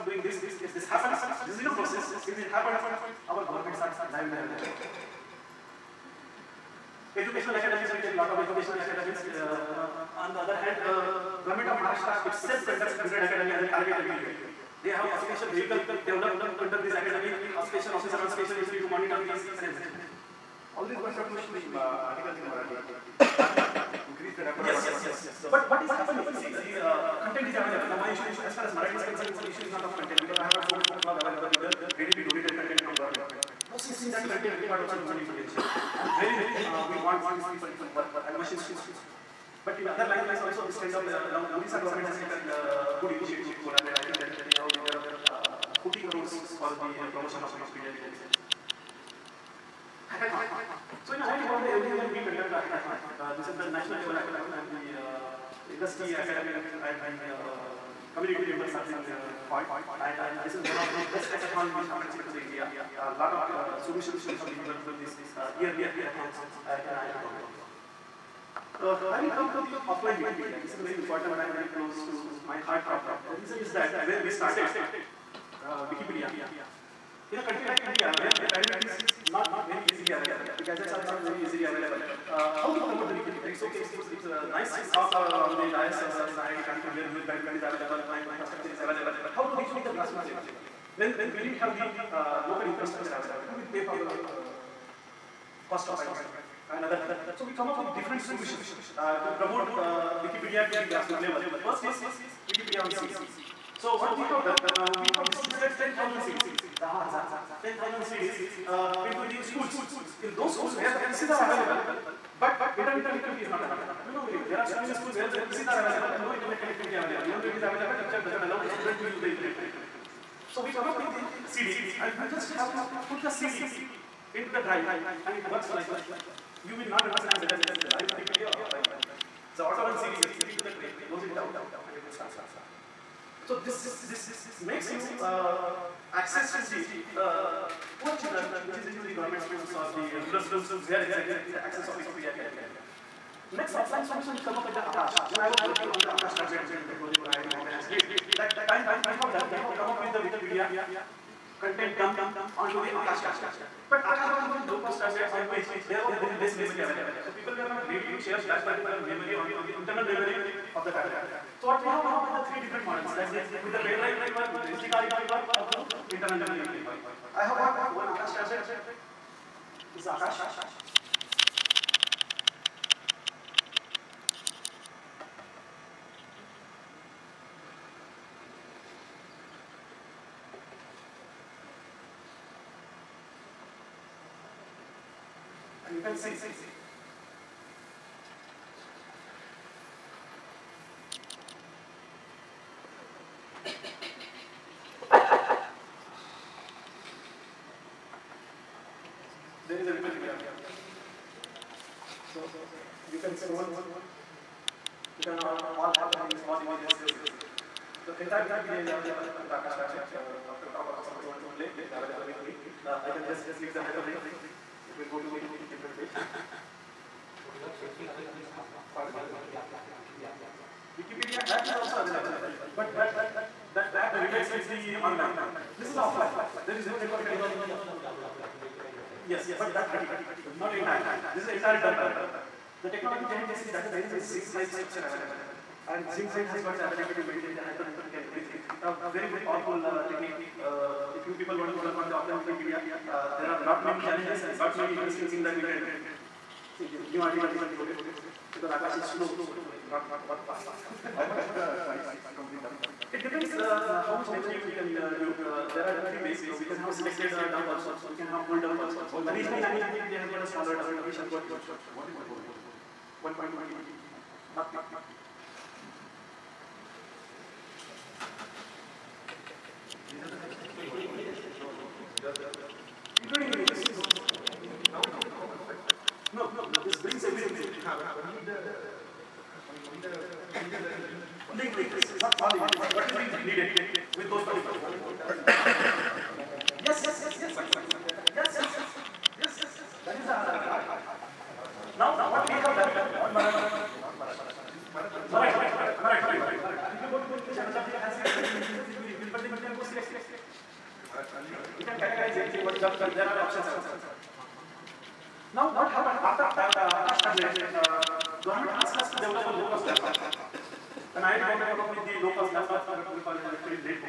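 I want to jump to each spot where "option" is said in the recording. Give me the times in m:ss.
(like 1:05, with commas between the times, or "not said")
3:47, 5:03.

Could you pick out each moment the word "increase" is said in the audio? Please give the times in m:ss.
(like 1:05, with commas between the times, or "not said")
0:24, 4:59.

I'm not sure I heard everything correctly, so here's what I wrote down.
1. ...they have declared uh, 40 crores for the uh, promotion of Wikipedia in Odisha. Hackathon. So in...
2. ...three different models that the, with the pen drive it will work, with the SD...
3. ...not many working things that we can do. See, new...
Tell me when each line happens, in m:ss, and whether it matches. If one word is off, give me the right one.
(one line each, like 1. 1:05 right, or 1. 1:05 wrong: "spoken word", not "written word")
1. 0:44 right
2. 2:42 right
3. 4:04 wrong: "interesting", not "working".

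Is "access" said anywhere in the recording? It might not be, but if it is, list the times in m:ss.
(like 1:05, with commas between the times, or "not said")
2:16, 2:21.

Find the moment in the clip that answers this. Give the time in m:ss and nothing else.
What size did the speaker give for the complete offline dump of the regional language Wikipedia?
4:23.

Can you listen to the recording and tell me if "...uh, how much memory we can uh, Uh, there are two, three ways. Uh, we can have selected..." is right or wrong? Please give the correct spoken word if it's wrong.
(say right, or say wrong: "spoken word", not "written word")
right.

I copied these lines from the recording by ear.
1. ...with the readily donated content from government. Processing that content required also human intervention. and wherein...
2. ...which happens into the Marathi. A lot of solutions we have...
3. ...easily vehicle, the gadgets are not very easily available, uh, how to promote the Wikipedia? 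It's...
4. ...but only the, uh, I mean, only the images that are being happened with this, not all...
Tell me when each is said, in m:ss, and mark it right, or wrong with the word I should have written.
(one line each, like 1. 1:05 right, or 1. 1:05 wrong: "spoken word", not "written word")
1. 0:31 right
2. 1:01 wrong: "India", not "Marathi"
3. 1:19 wrong: "available", not "vehicle"
4. 4:37 wrong: "linked", not "happened".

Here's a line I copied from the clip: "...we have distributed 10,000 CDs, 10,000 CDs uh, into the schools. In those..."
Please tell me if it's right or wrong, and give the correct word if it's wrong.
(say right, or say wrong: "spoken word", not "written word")
right.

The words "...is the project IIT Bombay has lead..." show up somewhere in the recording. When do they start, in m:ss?
2:26.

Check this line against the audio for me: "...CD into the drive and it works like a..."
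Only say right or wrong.
right.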